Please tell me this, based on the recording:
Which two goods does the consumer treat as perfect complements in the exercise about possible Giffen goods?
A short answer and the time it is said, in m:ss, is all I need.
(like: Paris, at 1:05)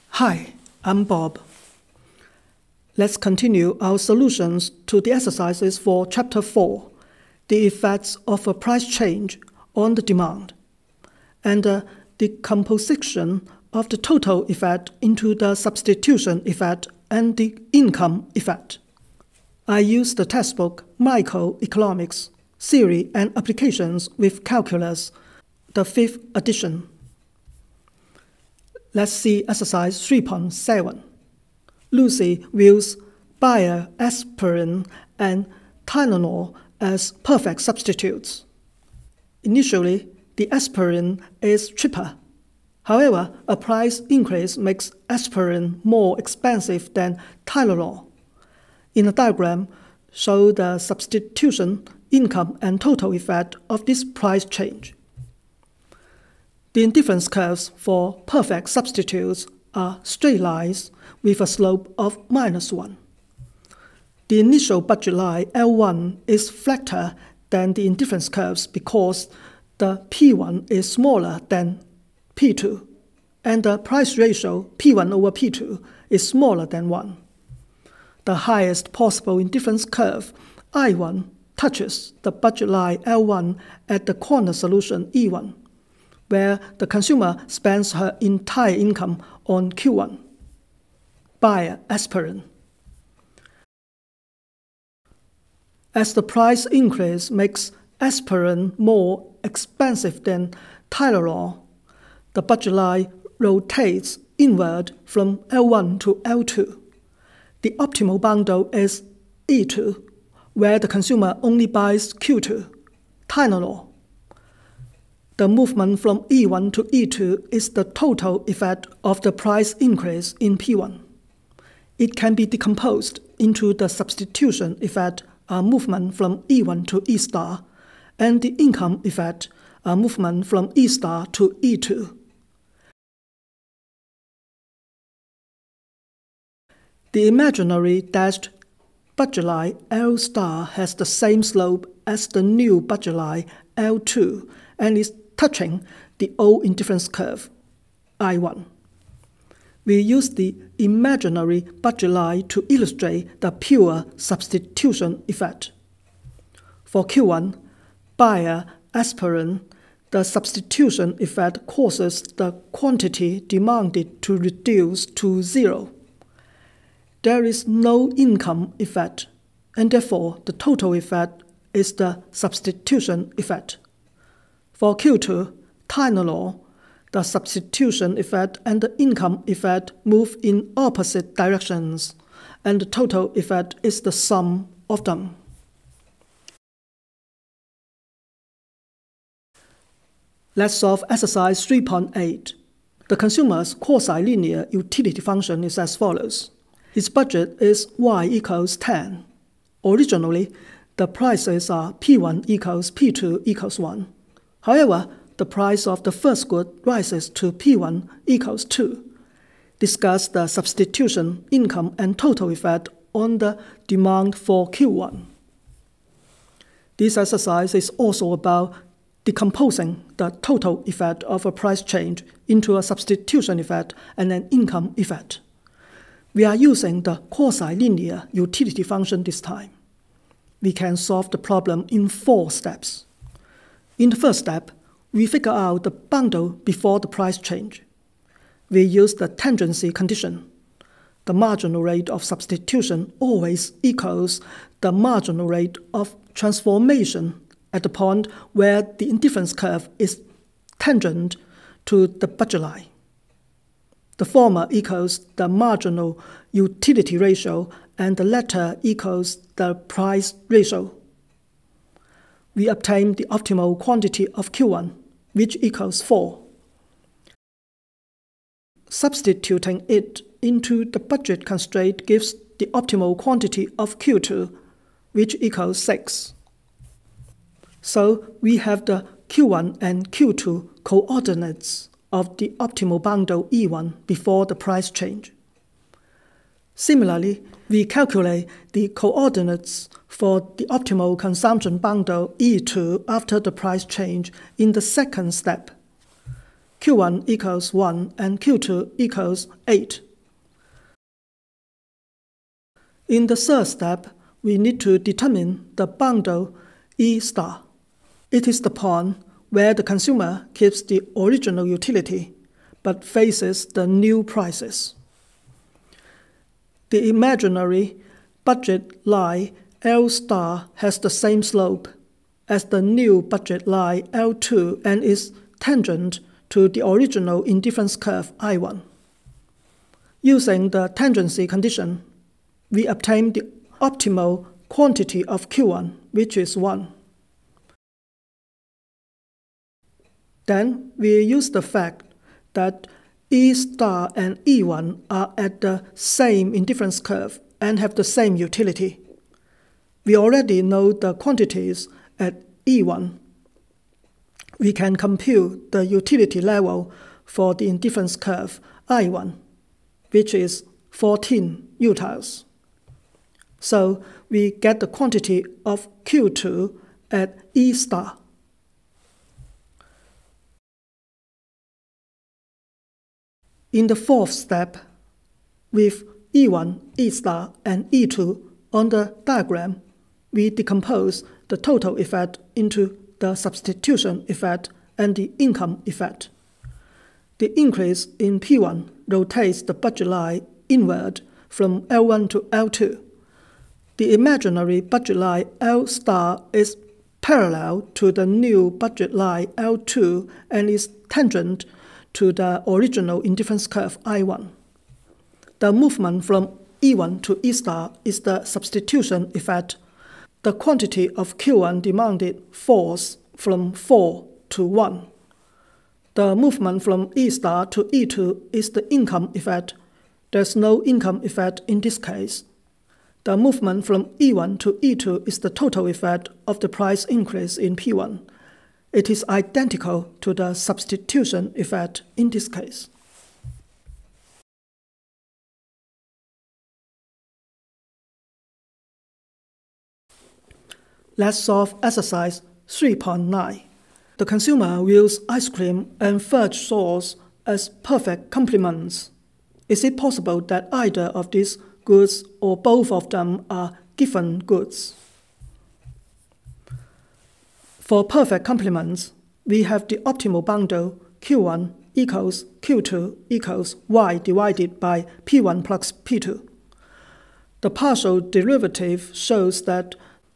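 ice cream and fudge sauce, at 7:25.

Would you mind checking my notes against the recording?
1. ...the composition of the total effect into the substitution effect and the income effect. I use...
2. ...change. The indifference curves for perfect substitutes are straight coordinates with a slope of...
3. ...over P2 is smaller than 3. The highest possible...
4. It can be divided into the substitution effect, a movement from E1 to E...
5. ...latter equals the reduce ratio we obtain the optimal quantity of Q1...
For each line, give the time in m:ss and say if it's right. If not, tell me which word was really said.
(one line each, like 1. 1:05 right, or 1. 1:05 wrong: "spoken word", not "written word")
1. 0:12 right
2. 0:54 wrong: "lines", not "coordinates"
3. 1:15 wrong: "1", not "3"
4. 2:01 wrong: "decomposed", not "divided"
5. 4:18 wrong: "price", not "reduce".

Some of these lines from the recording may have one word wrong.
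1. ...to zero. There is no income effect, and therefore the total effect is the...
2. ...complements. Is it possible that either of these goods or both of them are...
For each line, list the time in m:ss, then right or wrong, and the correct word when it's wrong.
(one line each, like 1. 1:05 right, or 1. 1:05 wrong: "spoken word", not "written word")
1. 2:45 right
2. 7:28 right.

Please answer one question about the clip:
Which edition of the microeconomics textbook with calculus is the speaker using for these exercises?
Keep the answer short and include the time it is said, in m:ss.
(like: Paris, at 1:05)
fifth edition, at 0:25.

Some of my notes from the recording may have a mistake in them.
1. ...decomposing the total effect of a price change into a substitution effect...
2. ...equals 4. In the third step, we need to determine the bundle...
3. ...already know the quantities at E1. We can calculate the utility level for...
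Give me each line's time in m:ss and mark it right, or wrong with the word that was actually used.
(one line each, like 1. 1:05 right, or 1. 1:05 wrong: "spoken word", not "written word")
1. 3:39 right
2. 4:58 wrong: "8", not "4"
3. 5:50 wrong: "compute", not "calculate".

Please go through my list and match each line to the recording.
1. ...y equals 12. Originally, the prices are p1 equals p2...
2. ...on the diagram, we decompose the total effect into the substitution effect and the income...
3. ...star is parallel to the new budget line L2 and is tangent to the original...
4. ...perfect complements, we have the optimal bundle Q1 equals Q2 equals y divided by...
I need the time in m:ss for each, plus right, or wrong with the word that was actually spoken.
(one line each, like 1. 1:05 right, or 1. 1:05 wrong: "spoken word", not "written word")
1. 3:17 wrong: "10", not "12"
2. 6:18 right
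3. 6:35 right
4. 7:38 right.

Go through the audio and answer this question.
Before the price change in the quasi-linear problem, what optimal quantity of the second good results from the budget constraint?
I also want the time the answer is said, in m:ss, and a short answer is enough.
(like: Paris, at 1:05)
6, at 4:35.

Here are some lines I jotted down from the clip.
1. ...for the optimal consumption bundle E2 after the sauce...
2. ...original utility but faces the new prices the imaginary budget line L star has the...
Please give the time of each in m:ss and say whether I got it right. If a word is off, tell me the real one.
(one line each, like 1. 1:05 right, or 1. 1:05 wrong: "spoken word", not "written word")
1. 4:50 wrong: "price", not "sauce"
2. 5:11 right.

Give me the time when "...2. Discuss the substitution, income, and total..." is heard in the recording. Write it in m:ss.
3:28.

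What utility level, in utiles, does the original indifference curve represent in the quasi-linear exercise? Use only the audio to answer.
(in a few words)
14.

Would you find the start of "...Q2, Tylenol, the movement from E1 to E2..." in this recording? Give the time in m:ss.
1:52.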